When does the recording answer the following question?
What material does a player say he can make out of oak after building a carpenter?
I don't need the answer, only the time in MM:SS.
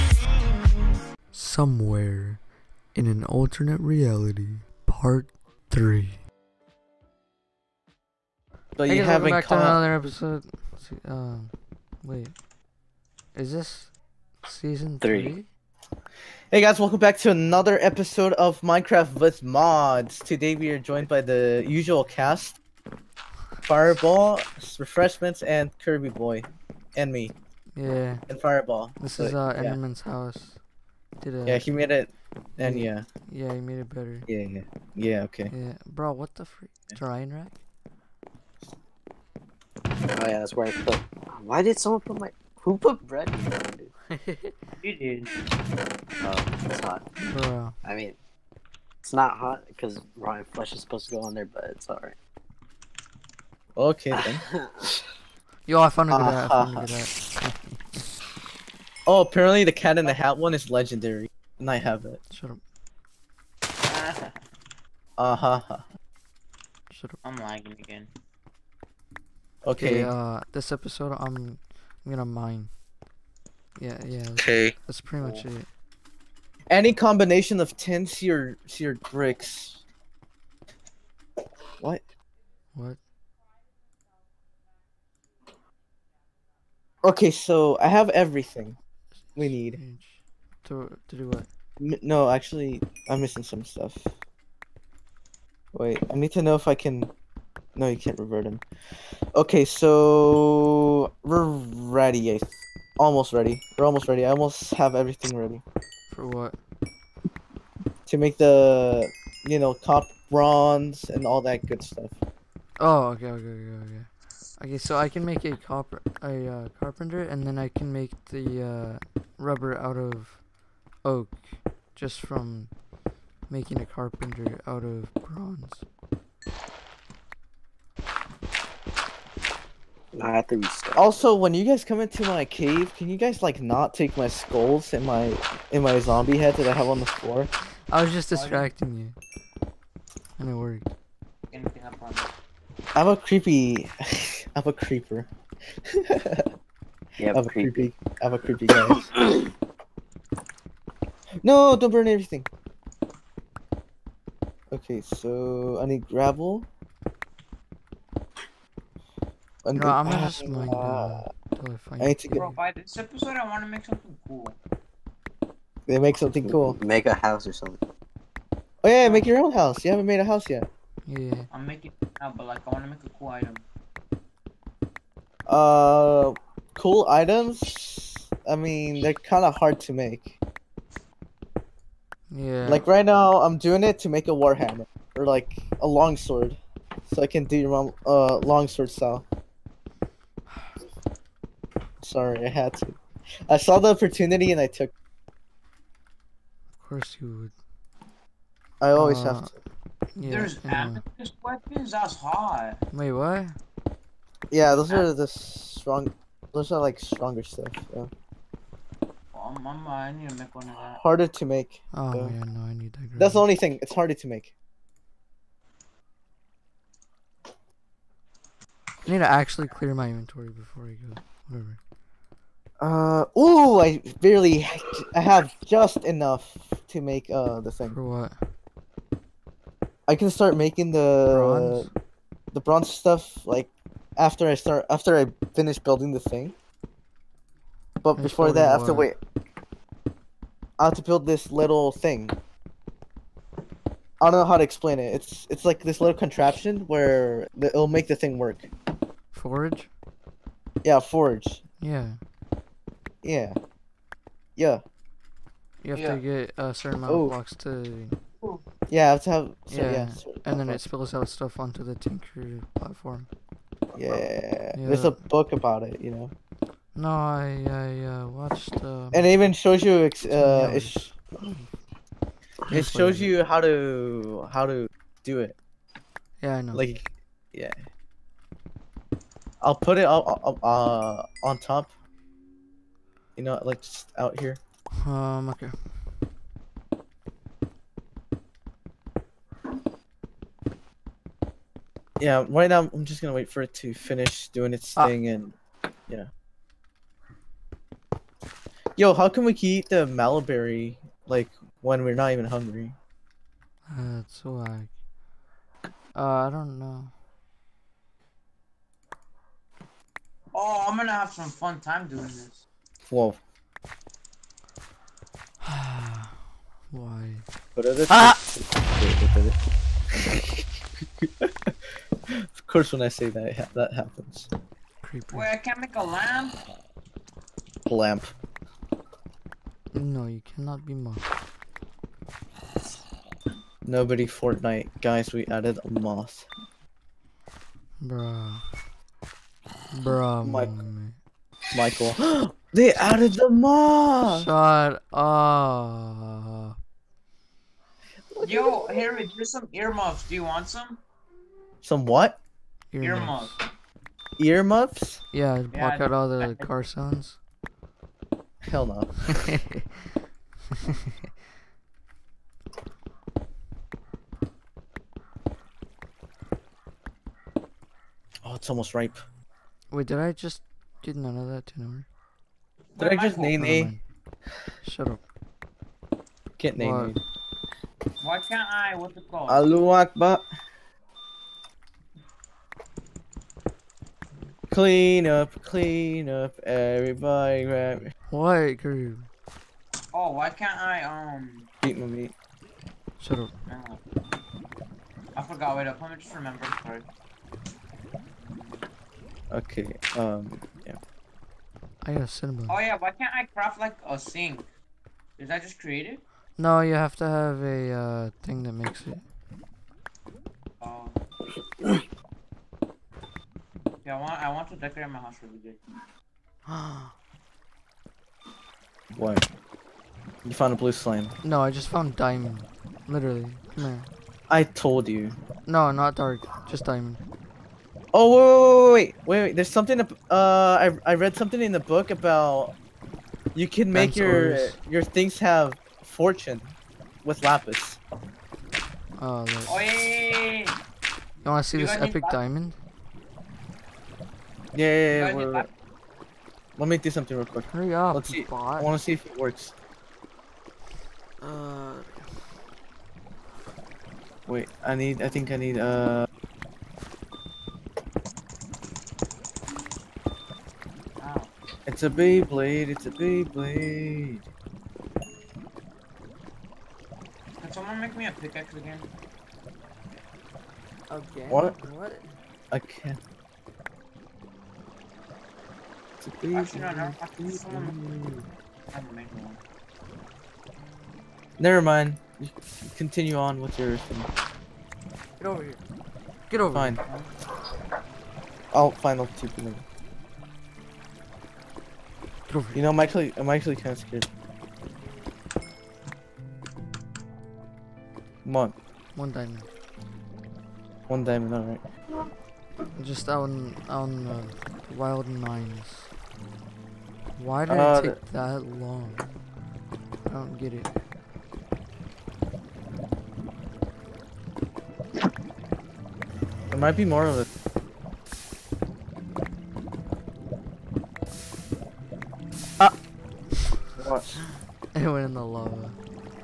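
01:59.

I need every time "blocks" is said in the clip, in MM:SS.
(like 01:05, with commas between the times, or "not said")
04:17, 05:55.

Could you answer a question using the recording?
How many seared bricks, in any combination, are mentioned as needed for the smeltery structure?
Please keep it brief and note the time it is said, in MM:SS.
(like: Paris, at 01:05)
10, at 01:17.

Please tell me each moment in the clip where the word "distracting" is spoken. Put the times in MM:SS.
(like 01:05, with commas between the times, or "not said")
02:18.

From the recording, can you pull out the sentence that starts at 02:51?
I'm making now, but like I want to make a cool item.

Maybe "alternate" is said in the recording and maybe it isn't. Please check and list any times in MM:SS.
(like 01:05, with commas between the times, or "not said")
00:03.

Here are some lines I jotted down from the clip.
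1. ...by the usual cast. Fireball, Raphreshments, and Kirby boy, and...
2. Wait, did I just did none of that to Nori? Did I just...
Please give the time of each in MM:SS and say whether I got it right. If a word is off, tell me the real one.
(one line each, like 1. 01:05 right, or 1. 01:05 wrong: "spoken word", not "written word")
1. 00:21 right
2. 06:09 right.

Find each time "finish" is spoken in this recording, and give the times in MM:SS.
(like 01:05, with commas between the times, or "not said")
03:55, 04:53.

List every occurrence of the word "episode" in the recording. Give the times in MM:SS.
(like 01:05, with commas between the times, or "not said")
00:09, 00:17, 01:10, 02:42.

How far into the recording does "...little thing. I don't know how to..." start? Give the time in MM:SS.
04:01.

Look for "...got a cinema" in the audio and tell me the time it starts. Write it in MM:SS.
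06:42.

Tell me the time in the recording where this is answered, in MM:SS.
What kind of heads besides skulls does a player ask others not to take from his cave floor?
02:15.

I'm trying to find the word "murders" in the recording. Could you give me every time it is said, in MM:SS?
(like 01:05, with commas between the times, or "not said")
not said.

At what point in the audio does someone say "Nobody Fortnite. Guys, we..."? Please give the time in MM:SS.
05:33.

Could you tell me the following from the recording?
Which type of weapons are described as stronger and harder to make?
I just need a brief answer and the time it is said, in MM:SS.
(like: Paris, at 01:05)
amethyst weapons, at 03:21.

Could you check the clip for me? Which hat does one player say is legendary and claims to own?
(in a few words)
Cat in the Hat.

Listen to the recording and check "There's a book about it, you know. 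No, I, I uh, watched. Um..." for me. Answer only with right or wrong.
right.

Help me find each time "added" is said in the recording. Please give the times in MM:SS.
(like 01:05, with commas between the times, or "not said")
05:35, 05:42.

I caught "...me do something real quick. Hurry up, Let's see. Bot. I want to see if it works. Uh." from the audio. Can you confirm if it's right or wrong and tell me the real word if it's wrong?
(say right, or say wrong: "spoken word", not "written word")
right.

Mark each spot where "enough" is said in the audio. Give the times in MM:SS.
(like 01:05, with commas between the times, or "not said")
03:46.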